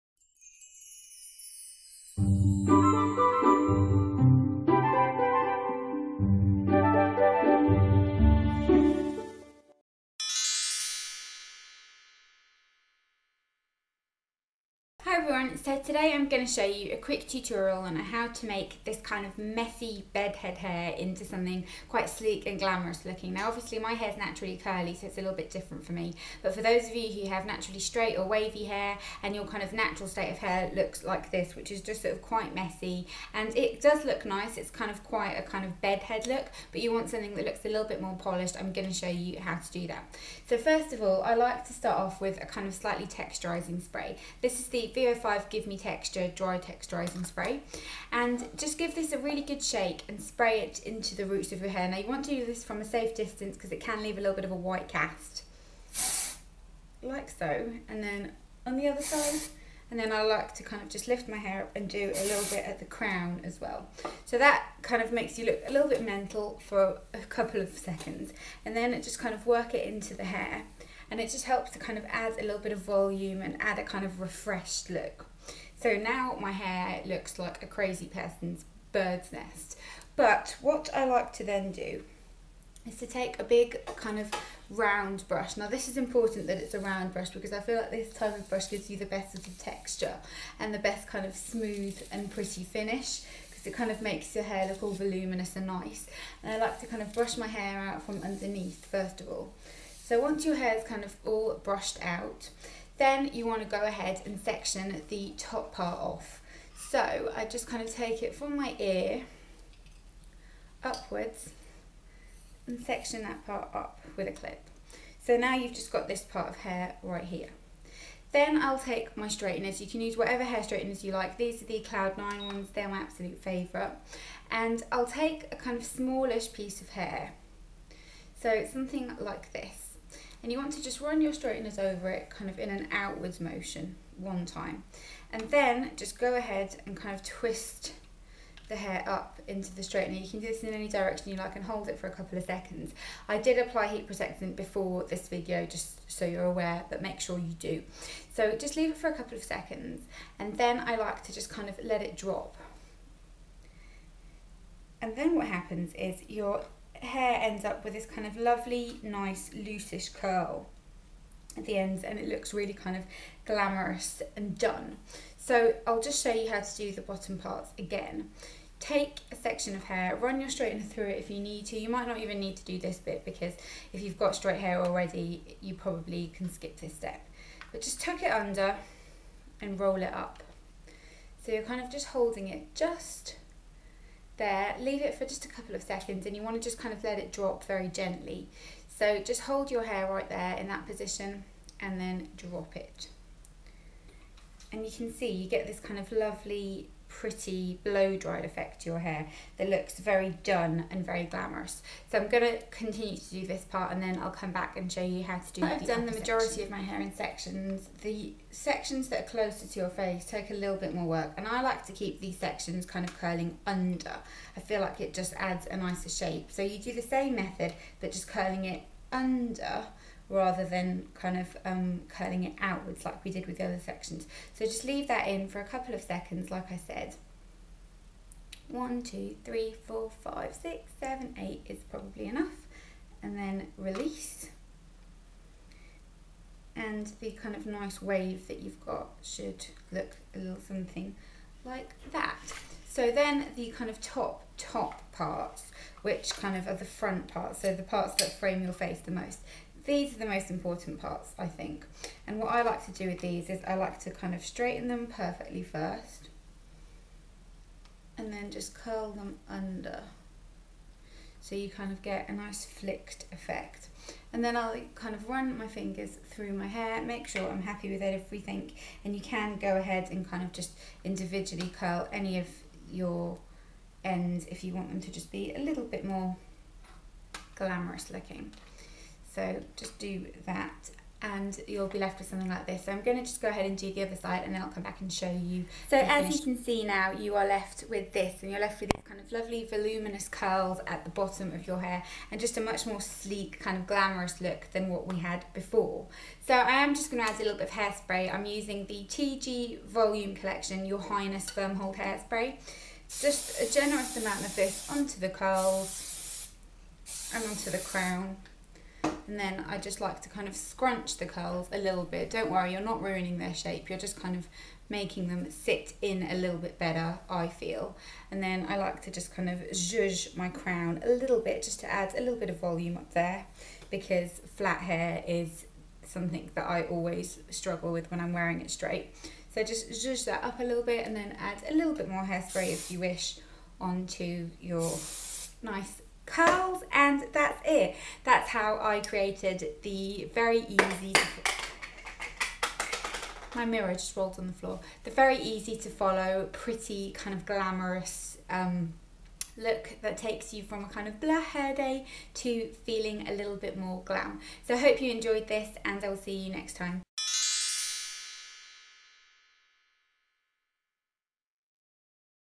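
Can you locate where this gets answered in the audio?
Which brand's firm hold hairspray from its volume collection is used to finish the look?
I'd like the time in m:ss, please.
4:59.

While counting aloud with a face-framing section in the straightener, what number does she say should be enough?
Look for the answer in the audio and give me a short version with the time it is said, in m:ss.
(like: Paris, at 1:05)
8, at 3:51.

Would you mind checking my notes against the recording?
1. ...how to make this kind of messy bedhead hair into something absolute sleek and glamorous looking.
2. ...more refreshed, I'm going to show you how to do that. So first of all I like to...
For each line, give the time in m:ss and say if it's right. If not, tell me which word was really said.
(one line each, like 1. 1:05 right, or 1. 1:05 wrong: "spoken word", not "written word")
1. 0:17 wrong: "quite", not "absolute"
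2. 0:38 wrong: "polished", not "refreshed".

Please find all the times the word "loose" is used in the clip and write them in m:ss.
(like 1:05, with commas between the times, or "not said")
2:39.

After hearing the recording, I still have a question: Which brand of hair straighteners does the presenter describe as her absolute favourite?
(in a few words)
Cloud9.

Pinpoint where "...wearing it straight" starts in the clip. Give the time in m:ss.
5:28.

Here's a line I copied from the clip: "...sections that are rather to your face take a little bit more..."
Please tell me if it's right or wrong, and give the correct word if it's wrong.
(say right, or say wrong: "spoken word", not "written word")
wrong: "closer", not "rather".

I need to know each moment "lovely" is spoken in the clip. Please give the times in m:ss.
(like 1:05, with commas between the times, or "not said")
2:38, 3:16, 4:49.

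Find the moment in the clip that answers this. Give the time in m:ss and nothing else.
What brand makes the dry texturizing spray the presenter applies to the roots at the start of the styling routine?
0:44.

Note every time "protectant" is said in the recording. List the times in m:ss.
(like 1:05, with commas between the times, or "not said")
2:24.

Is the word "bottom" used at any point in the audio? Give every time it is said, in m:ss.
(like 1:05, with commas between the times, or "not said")
2:47, 4:51.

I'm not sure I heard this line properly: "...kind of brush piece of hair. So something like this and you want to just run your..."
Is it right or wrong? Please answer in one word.
wrong.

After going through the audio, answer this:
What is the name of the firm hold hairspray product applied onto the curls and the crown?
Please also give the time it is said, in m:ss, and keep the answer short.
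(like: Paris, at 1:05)
Your Highness, at 5:00.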